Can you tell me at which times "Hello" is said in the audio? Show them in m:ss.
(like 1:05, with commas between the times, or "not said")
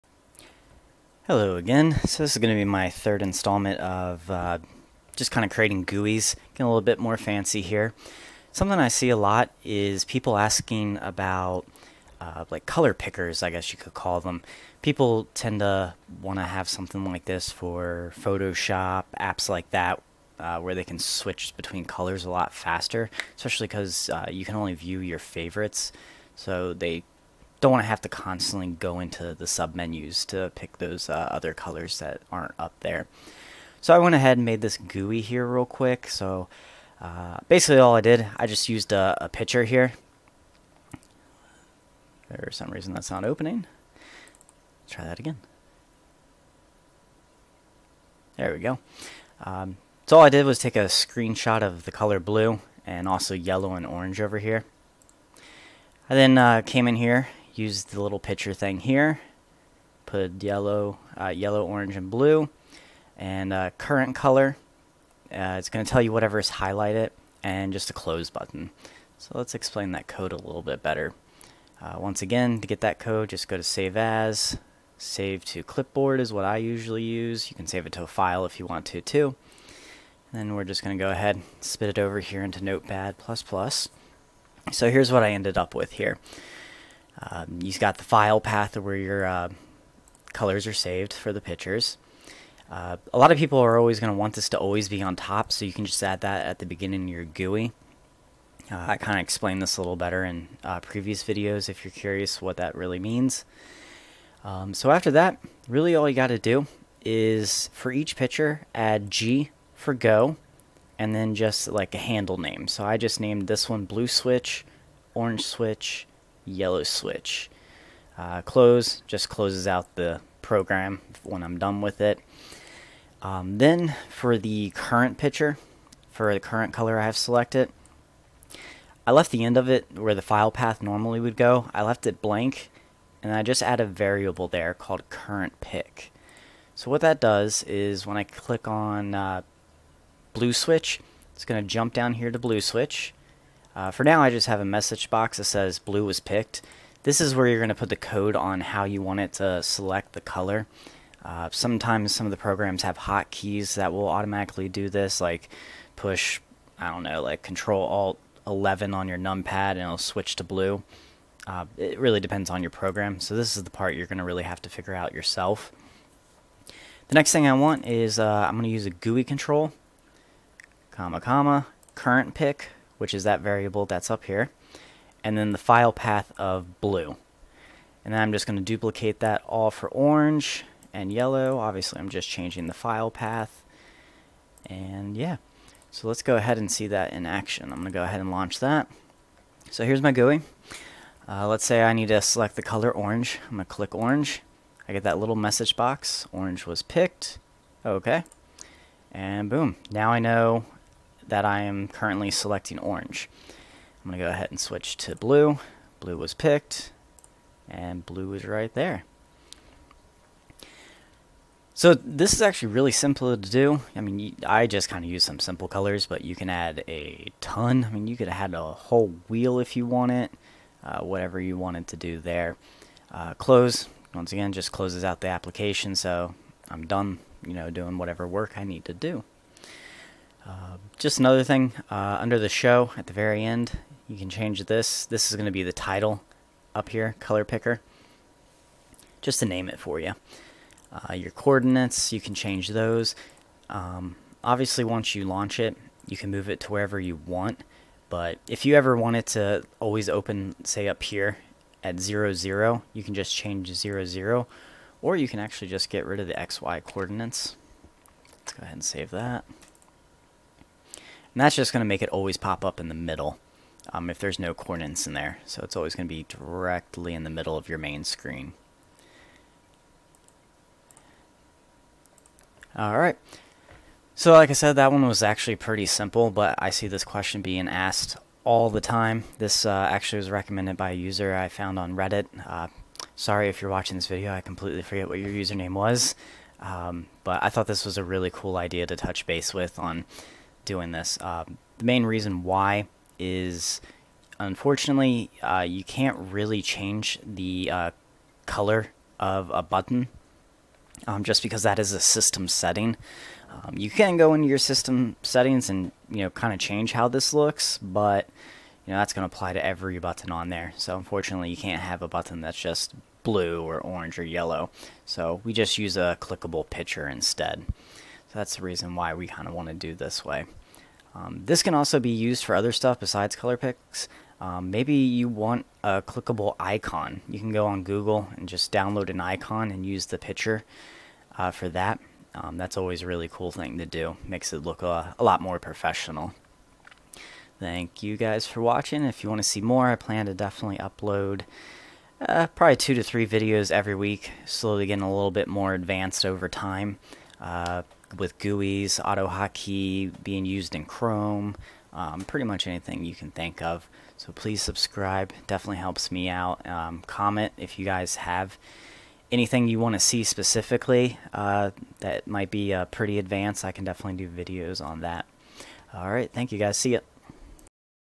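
0:01.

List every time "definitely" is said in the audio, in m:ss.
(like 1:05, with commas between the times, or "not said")
5:40, 5:55, 6:03.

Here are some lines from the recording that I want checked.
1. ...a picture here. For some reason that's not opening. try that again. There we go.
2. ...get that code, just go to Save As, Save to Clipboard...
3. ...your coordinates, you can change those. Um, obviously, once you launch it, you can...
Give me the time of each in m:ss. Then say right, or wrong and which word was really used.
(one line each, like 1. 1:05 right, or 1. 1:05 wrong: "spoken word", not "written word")
1. 0:39 right
2. 1:12 right
3. 4:01 right.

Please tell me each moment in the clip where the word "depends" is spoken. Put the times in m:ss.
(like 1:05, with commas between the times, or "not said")
2:42.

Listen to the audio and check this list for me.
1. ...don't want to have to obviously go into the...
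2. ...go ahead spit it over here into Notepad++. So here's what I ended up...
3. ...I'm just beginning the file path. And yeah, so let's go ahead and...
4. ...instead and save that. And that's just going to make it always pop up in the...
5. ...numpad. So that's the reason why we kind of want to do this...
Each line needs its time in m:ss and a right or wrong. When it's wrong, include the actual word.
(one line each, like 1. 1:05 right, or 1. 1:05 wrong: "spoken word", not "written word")
1. 0:27 wrong: "constantly", not "obviously"
2. 1:21 right
3. 3:01 wrong: "changing", not "beginning"
4. 4:18 wrong: "ahead", not "instead"
5. 5:17 wrong: "instead", not "numpad".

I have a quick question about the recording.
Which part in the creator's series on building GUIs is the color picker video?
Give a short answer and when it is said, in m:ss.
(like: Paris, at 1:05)
Third, at 0:02.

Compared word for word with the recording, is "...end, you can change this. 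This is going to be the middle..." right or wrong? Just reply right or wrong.
wrong.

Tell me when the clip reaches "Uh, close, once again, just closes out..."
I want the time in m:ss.
3:43.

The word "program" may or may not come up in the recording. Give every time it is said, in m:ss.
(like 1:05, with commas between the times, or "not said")
2:00, 2:32, 2:42.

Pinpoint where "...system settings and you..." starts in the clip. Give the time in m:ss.
5:04.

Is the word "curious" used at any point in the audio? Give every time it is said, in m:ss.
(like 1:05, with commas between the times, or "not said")
1:41.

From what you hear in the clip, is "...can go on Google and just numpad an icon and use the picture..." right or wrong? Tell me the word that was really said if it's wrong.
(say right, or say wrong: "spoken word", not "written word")
wrong: "download", not "numpad".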